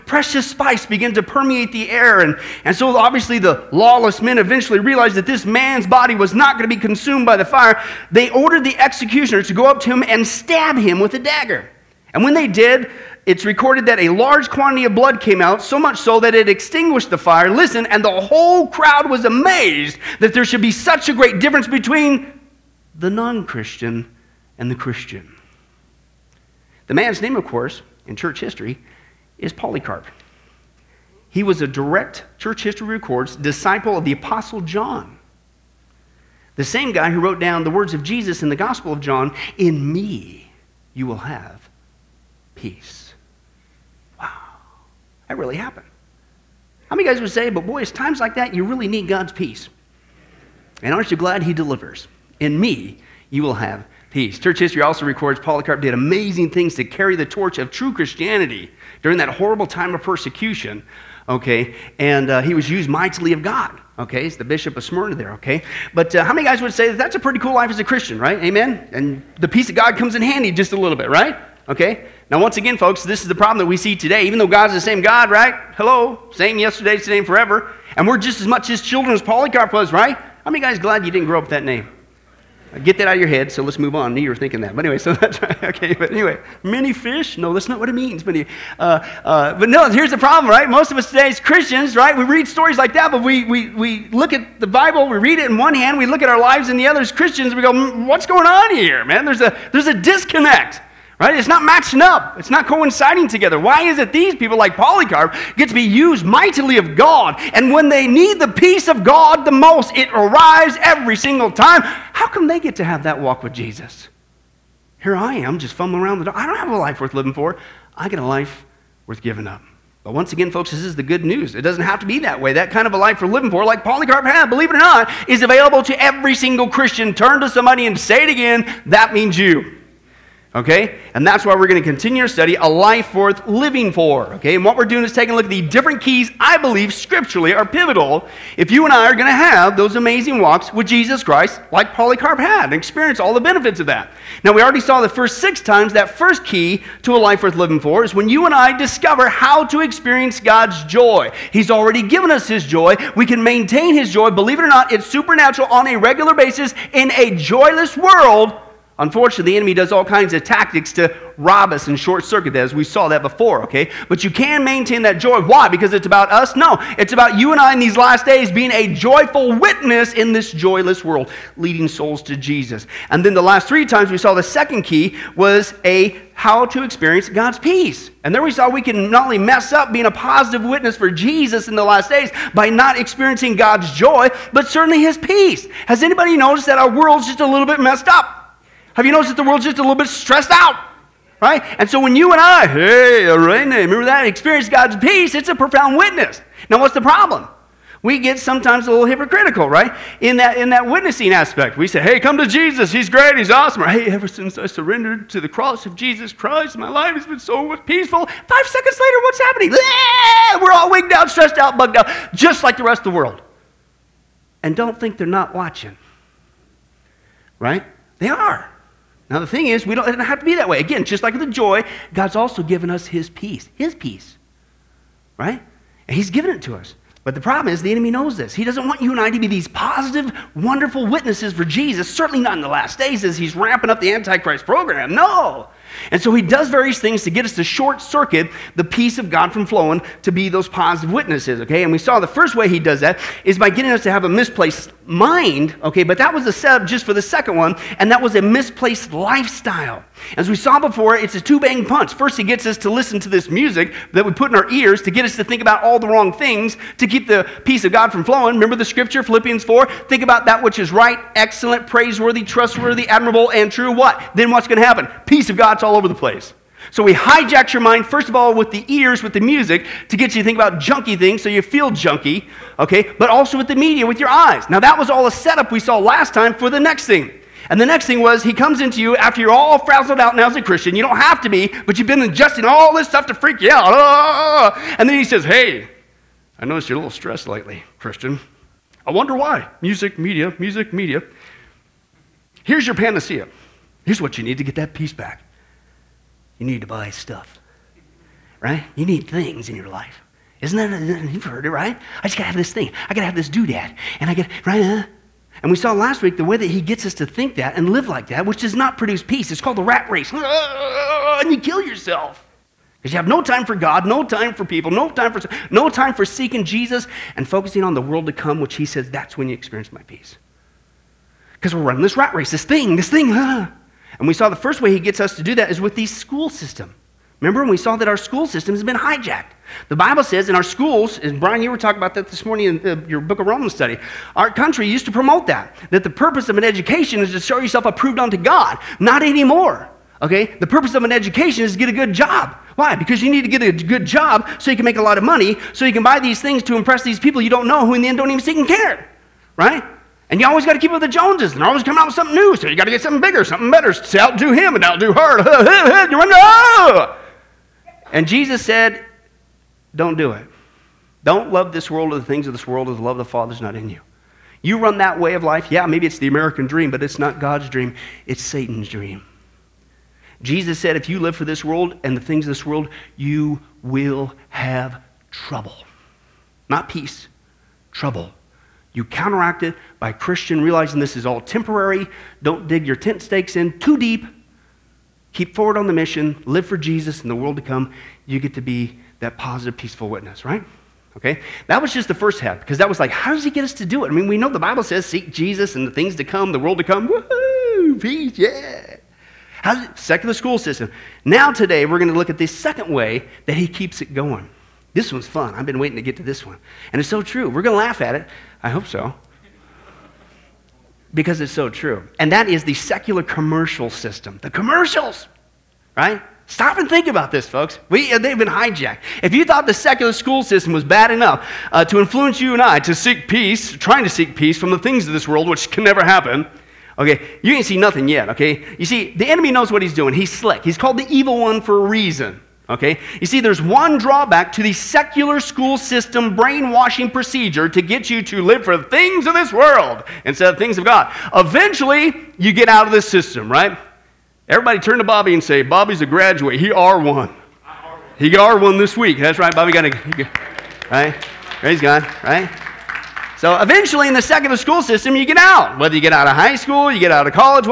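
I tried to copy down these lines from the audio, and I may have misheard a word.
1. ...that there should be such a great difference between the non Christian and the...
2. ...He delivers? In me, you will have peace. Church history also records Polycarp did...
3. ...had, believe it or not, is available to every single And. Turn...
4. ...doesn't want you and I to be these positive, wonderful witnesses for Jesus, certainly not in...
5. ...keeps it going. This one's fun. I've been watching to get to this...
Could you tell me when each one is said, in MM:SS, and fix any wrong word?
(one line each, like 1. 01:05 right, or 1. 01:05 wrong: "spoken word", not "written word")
1. 00:20 right
2. 00:51 right
3. 02:04 wrong: "Christian", not "And"
4. 03:48 right
5. 06:43 wrong: "waiting", not "watching".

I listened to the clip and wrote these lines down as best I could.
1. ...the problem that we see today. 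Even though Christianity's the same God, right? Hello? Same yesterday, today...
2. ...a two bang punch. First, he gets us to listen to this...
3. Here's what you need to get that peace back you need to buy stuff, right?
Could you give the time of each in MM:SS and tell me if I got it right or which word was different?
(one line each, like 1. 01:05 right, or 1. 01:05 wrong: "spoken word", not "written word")
1. 01:13 wrong: "God", not "Christianity"
2. 04:11 right
3. 04:54 right.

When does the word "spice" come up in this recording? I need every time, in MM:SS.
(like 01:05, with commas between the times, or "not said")
00:00.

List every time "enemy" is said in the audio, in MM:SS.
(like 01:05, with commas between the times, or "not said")
02:39, 03:47, 07:09.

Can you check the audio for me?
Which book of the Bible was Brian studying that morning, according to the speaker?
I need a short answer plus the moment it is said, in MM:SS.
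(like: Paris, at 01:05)
Romans, at 05:33.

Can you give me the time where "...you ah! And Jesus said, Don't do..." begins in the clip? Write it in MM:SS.
05:56.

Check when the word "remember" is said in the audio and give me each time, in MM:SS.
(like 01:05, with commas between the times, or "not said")
03:13, 04:18, 05:27.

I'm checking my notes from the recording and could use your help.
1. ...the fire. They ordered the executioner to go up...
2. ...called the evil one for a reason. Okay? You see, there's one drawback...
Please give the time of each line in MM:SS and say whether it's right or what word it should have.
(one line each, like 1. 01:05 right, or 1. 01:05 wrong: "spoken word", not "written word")
1. 00:07 right
2. 07:10 right.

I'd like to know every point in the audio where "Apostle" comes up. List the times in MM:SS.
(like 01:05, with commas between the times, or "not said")
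00:34.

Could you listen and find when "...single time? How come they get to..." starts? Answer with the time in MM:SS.
01:51.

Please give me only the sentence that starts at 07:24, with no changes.
Everybody turn to Bobby and say, Bobby's a graduate.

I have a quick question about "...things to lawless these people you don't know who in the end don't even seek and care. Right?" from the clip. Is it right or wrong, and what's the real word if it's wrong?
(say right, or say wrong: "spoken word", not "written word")
wrong: "impress", not "lawless".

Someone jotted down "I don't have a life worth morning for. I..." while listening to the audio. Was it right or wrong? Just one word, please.
wrong.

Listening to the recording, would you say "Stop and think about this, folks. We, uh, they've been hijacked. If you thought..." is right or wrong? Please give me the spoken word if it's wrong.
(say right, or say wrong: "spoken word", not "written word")
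right.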